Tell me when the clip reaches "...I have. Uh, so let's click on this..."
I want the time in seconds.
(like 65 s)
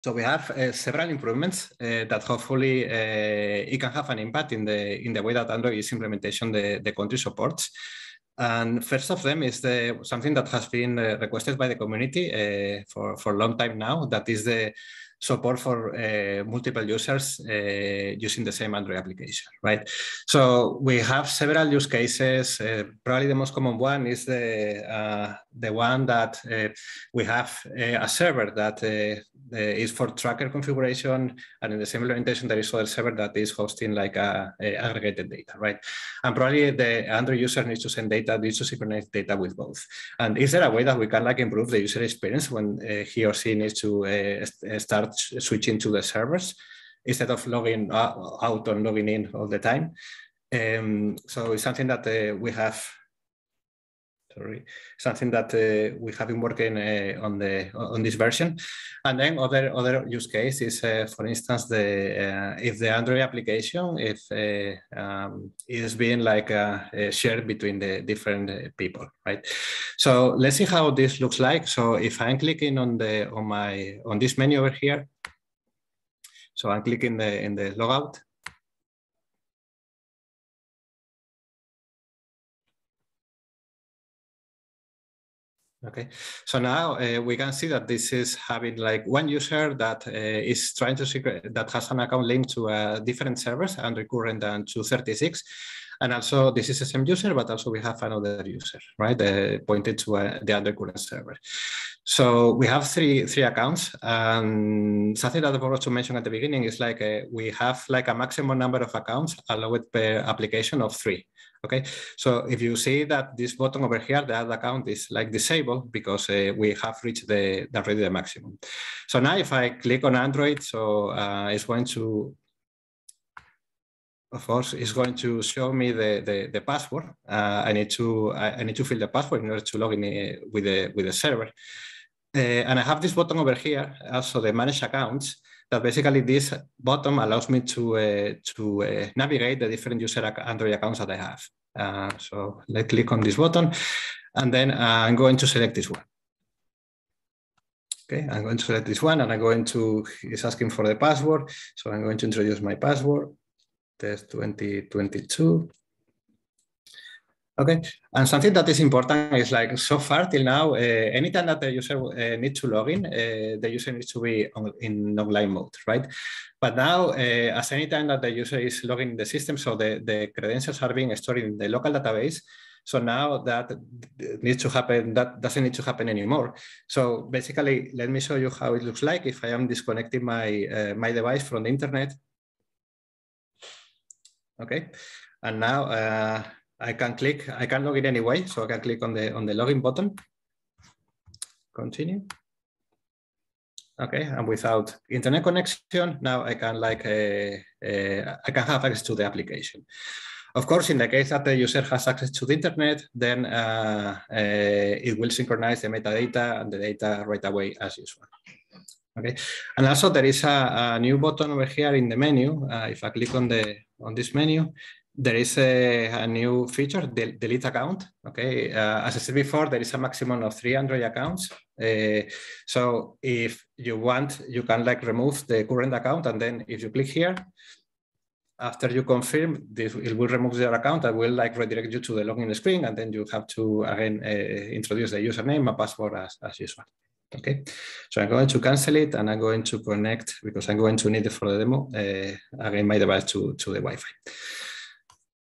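141 s.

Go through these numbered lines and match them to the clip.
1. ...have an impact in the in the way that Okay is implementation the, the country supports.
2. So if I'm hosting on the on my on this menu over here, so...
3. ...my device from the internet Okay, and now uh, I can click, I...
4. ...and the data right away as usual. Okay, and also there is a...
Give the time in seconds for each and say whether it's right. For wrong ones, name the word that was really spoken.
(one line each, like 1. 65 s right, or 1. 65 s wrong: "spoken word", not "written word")
1. 3 s wrong: "Android", not "Okay"
2. 71 s wrong: "clicking", not "hosting"
3. 180 s right
4. 206 s right.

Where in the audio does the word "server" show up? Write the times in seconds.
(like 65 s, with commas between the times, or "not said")
28 s, 32 s, 46 s, 93 s, 100 s, 131 s.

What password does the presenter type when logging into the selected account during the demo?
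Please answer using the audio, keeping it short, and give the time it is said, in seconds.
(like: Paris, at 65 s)
test 2022, at 154 s.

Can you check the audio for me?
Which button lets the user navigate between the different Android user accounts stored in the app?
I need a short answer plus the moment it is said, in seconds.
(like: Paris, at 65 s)
Manage accounts, at 134 s.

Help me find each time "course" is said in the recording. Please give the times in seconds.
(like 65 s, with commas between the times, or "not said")
124 s, 200 s.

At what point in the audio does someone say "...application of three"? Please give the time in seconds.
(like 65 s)
110 s.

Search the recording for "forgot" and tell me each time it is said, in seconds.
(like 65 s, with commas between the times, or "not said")
105 s.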